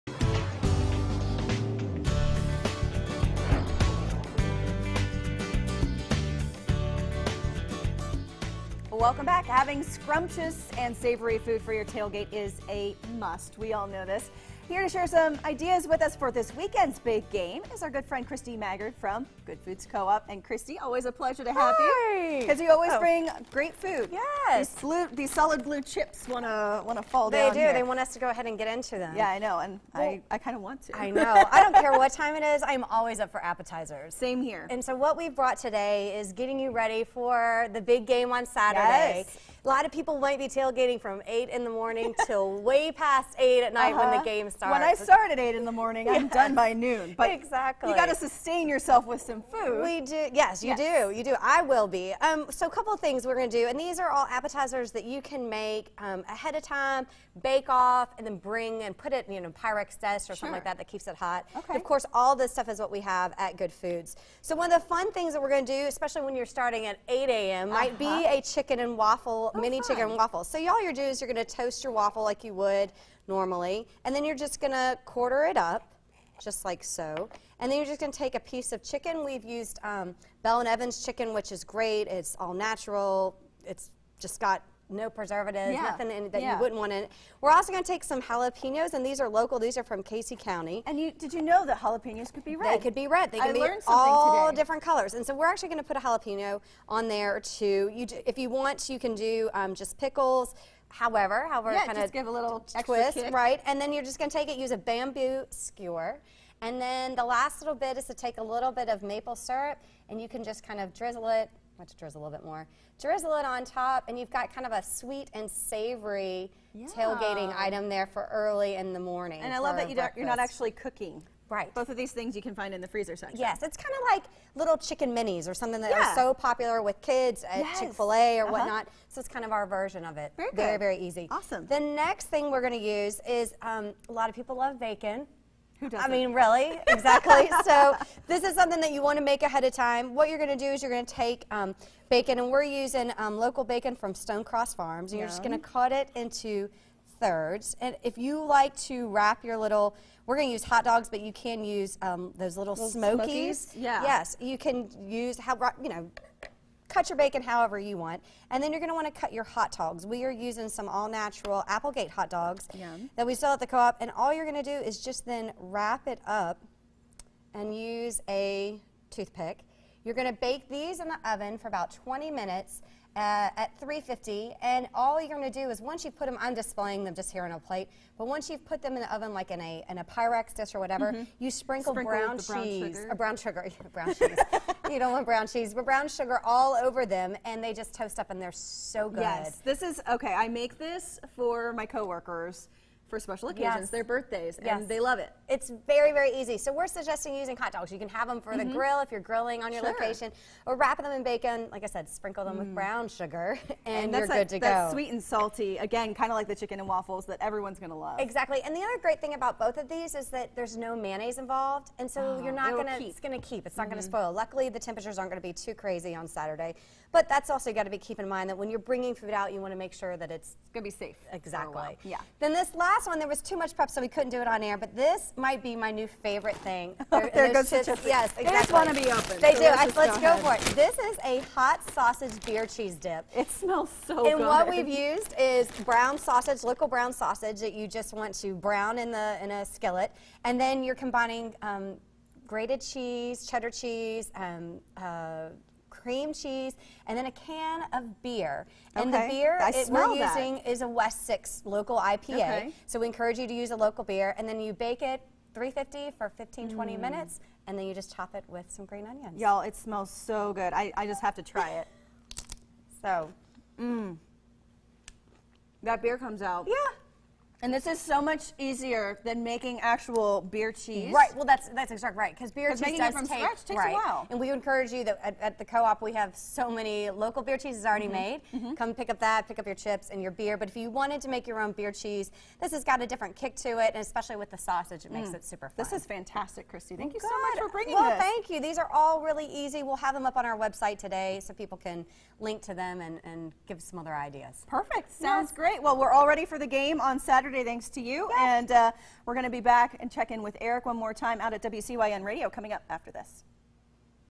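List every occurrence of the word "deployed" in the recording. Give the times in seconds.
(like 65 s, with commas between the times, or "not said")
not said.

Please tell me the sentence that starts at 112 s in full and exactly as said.
Drizzle it on top, and you've got kind of a sweet and savory yeah.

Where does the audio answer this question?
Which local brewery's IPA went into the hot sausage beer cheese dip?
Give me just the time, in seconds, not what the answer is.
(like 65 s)
250 s.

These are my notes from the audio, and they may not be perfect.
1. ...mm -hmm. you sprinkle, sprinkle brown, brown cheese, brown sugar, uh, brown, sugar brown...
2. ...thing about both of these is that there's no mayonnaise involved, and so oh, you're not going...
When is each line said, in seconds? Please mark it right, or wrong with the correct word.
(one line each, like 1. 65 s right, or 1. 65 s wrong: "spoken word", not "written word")
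1. 181 s right
2. 209 s right.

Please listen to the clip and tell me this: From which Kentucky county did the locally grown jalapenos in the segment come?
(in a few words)
Casey County.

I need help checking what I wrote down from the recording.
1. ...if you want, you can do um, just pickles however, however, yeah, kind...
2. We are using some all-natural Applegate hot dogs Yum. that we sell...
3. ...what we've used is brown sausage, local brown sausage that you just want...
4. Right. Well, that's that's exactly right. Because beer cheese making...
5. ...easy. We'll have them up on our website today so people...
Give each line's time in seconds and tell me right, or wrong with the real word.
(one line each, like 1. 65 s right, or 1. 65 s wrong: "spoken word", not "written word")
1. 98 s right
2. 160 s right
3. 234 s right
4. 271 s right
5. 289 s right.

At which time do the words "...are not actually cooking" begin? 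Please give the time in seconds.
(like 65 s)
119 s.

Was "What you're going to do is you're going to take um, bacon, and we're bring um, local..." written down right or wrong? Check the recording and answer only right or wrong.
wrong.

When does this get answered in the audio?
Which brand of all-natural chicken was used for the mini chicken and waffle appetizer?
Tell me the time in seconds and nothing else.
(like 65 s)
80 s.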